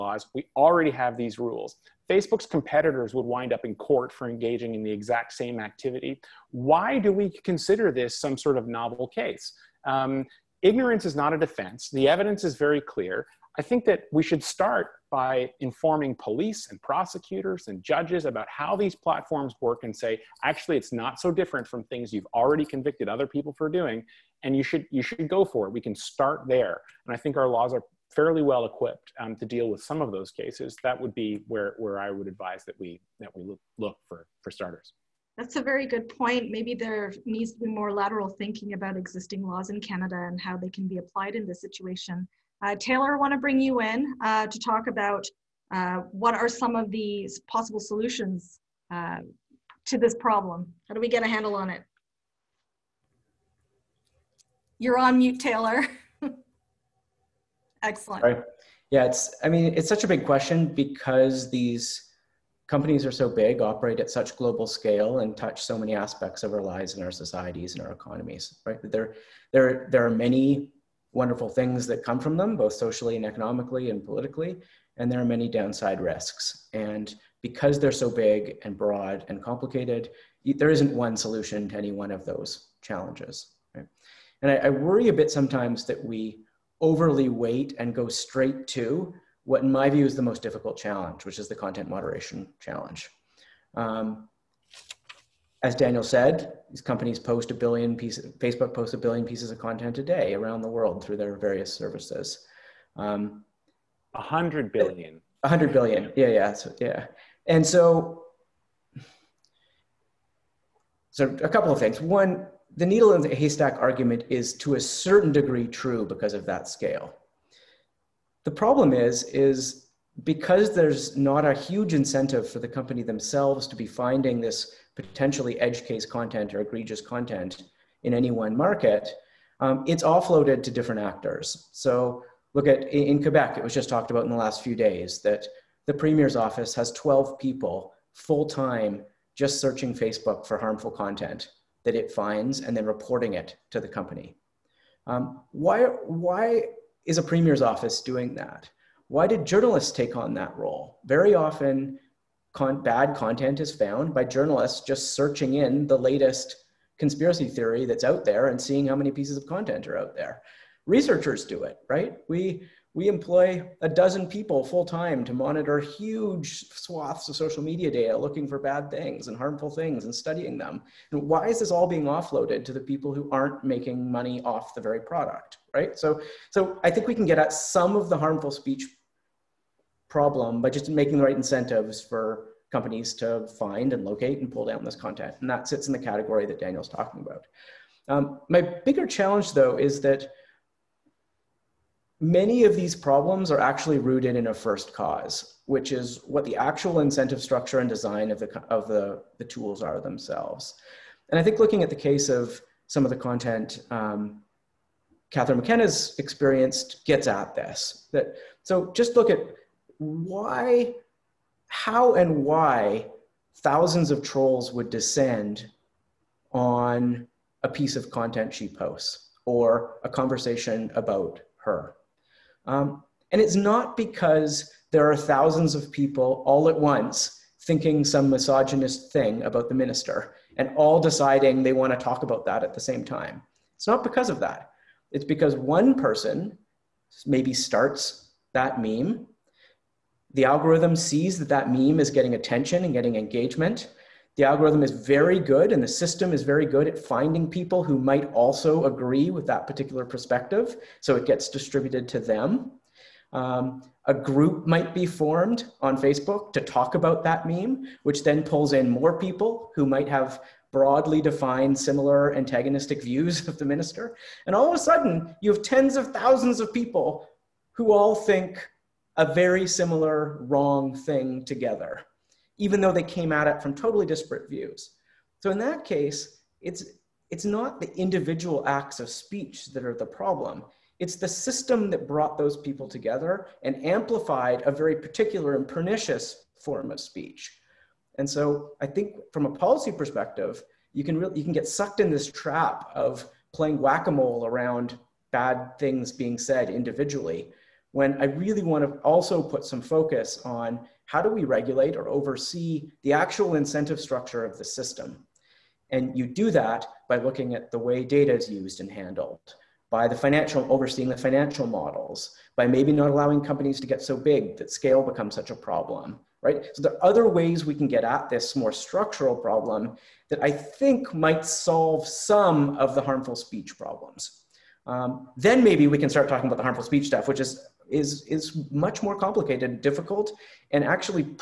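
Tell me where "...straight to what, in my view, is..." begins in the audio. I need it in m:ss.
1:28.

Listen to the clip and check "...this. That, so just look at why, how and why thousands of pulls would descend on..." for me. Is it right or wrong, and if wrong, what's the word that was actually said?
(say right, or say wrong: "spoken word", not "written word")
wrong: "trolls", not "pulls".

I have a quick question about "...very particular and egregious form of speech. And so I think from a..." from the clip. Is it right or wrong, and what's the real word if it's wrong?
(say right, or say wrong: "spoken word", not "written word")
wrong: "pernicious", not "egregious".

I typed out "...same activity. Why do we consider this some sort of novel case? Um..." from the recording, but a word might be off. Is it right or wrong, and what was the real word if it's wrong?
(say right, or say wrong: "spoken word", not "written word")
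right.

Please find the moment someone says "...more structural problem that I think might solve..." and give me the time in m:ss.
5:18.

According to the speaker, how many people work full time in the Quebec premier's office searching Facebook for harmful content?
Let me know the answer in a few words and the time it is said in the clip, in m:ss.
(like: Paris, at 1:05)
12, at 2:16.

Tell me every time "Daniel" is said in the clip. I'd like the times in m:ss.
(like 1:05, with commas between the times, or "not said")
1:35, 3:06.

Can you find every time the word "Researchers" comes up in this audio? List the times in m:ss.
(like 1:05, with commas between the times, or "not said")
2:40.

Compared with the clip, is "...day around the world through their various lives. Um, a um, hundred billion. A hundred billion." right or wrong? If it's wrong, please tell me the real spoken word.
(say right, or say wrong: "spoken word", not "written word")
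wrong: "services", not "lives".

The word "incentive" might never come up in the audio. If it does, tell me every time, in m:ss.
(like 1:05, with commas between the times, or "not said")
2:01, 3:01, 3:16, 5:03.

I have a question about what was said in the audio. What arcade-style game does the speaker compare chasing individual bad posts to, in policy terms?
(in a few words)
whack-a-mole.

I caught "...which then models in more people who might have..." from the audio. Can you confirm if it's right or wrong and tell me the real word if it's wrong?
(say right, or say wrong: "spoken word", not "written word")
wrong: "pulls", not "models".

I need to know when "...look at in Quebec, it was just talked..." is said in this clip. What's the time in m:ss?
2:12.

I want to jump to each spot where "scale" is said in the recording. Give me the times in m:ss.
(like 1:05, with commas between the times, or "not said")
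1:04, 1:56, 5:14.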